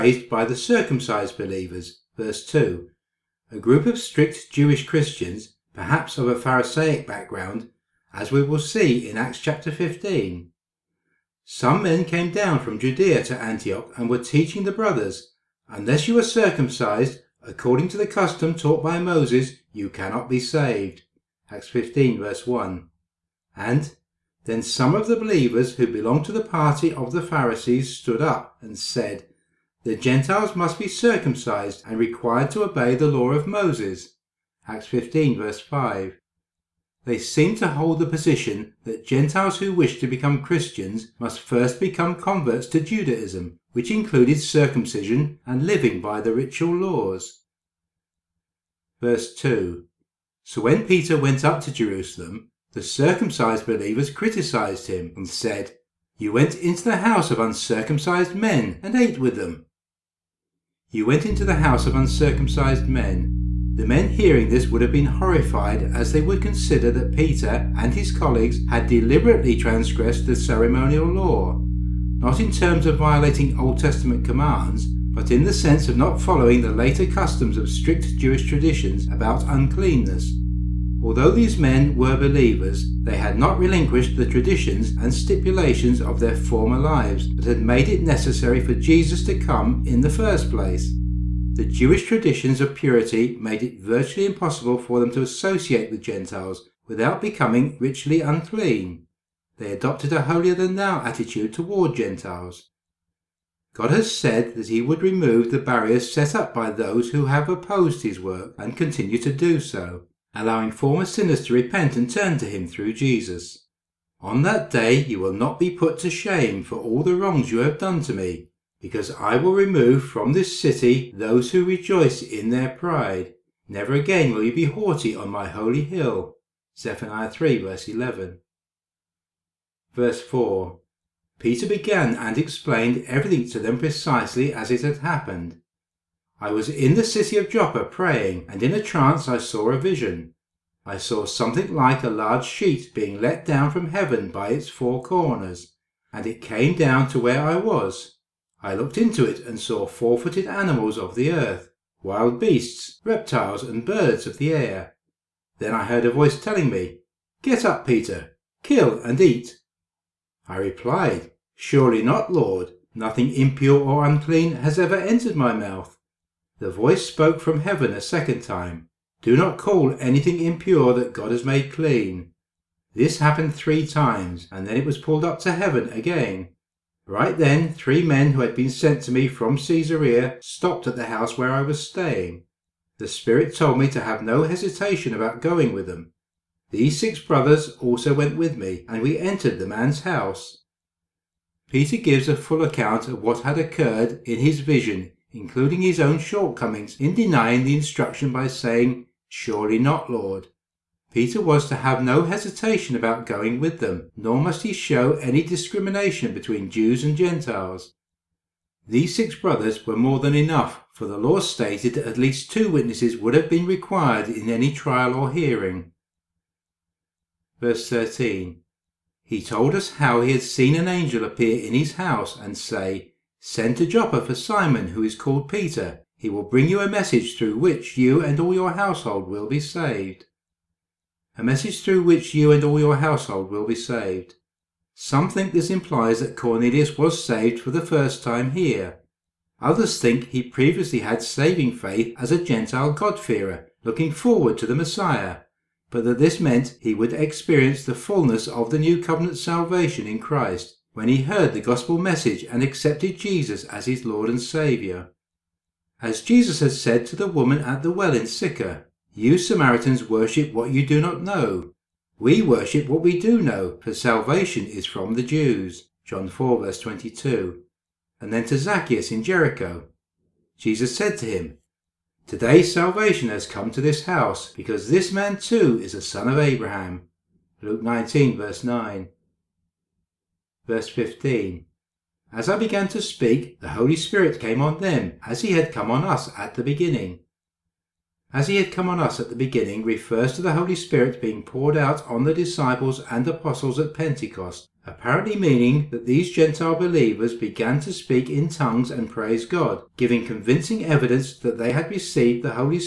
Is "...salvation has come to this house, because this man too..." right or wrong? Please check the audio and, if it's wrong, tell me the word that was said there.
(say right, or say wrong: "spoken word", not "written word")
right.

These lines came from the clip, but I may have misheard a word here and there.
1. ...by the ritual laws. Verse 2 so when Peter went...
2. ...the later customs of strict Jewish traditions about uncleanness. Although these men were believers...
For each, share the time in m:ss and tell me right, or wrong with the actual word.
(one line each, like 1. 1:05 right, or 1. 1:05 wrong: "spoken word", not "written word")
1. 0:46 right
2. 1:16 right.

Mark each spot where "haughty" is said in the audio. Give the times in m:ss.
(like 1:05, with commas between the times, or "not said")
2:04.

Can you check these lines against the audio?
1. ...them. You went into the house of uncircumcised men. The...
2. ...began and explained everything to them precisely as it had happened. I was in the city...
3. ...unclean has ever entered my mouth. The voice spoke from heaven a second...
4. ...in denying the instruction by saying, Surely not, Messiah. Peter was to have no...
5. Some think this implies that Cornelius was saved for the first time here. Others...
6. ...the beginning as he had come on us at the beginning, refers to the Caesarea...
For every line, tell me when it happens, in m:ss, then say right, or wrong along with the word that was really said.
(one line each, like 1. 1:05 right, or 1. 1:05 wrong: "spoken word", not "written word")
1. 0:59 right
2. 2:11 right
3. 2:44 right
4. 3:16 wrong: "Lord", not "Messiah"
5. 3:54 right
6. 4:46 wrong: "Holy", not "Caesarea".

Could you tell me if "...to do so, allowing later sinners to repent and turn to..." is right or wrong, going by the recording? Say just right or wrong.
wrong.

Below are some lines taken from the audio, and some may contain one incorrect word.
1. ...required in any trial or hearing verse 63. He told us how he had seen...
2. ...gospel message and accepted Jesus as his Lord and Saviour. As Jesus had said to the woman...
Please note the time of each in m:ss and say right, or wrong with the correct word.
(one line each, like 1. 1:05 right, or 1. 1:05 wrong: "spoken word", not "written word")
1. 3:33 wrong: "13", not "63"
2. 4:11 right.